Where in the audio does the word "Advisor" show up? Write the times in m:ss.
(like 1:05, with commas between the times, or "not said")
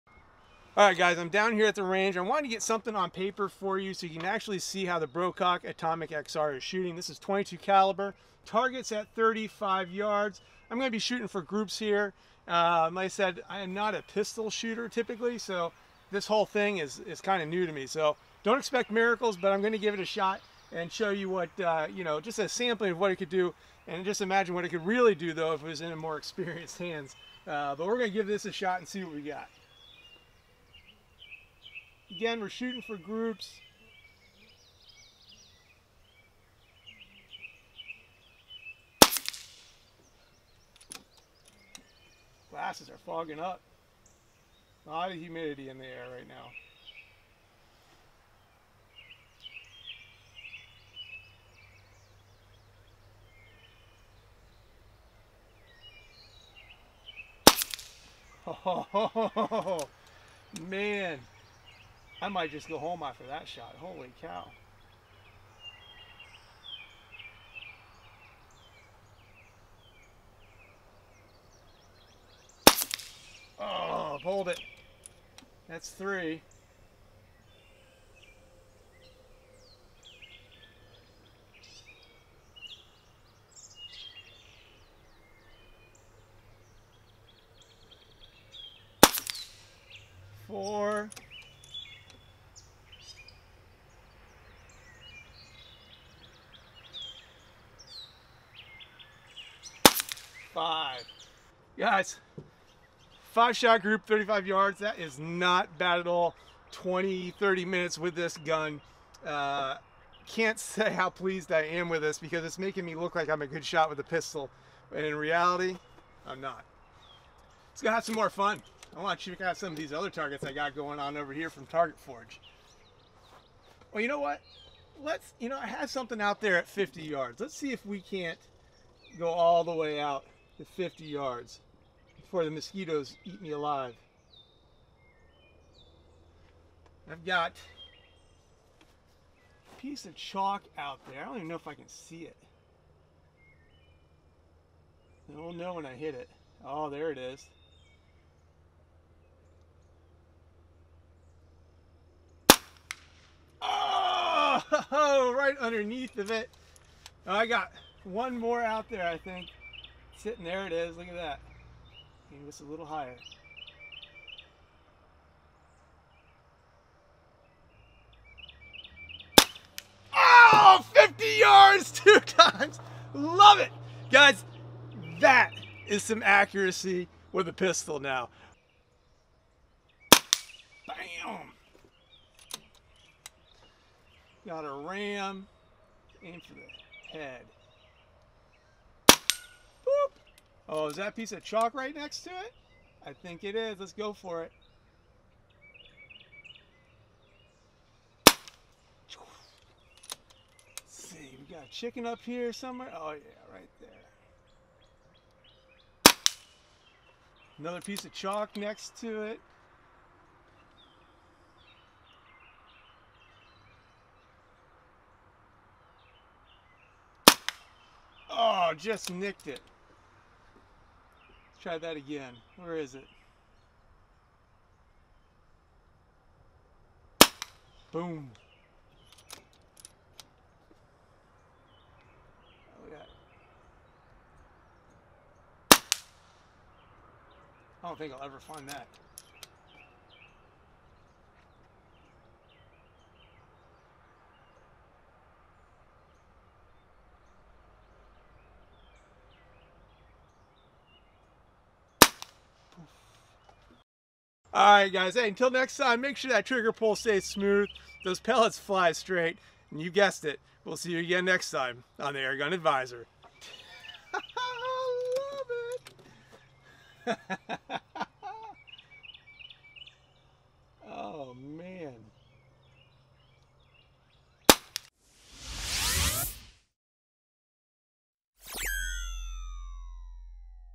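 4:22.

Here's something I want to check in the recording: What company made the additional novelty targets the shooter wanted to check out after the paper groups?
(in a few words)
Target Forge.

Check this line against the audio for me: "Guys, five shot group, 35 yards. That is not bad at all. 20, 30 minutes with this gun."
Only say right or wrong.
right.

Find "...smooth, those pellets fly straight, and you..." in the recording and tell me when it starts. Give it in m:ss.
4:17.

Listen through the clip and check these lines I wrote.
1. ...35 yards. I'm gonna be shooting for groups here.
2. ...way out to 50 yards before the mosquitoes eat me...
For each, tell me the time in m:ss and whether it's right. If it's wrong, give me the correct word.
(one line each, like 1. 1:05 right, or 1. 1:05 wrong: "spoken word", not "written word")
1. 0:09 right
2. 2:09 right.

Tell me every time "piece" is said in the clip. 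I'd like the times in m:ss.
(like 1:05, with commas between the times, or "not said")
2:19, 3:11, 3:27.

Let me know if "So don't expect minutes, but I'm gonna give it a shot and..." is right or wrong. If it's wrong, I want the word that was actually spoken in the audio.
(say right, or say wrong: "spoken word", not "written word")
wrong: "miracles", not "minutes".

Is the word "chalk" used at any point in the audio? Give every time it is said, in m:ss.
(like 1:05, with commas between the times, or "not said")
2:20, 3:11, 3:28.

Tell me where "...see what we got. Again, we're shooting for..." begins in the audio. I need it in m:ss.
0:28.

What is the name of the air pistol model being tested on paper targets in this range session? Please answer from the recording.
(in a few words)
Brocock Atomic XR.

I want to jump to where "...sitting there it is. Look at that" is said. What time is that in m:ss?
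2:40.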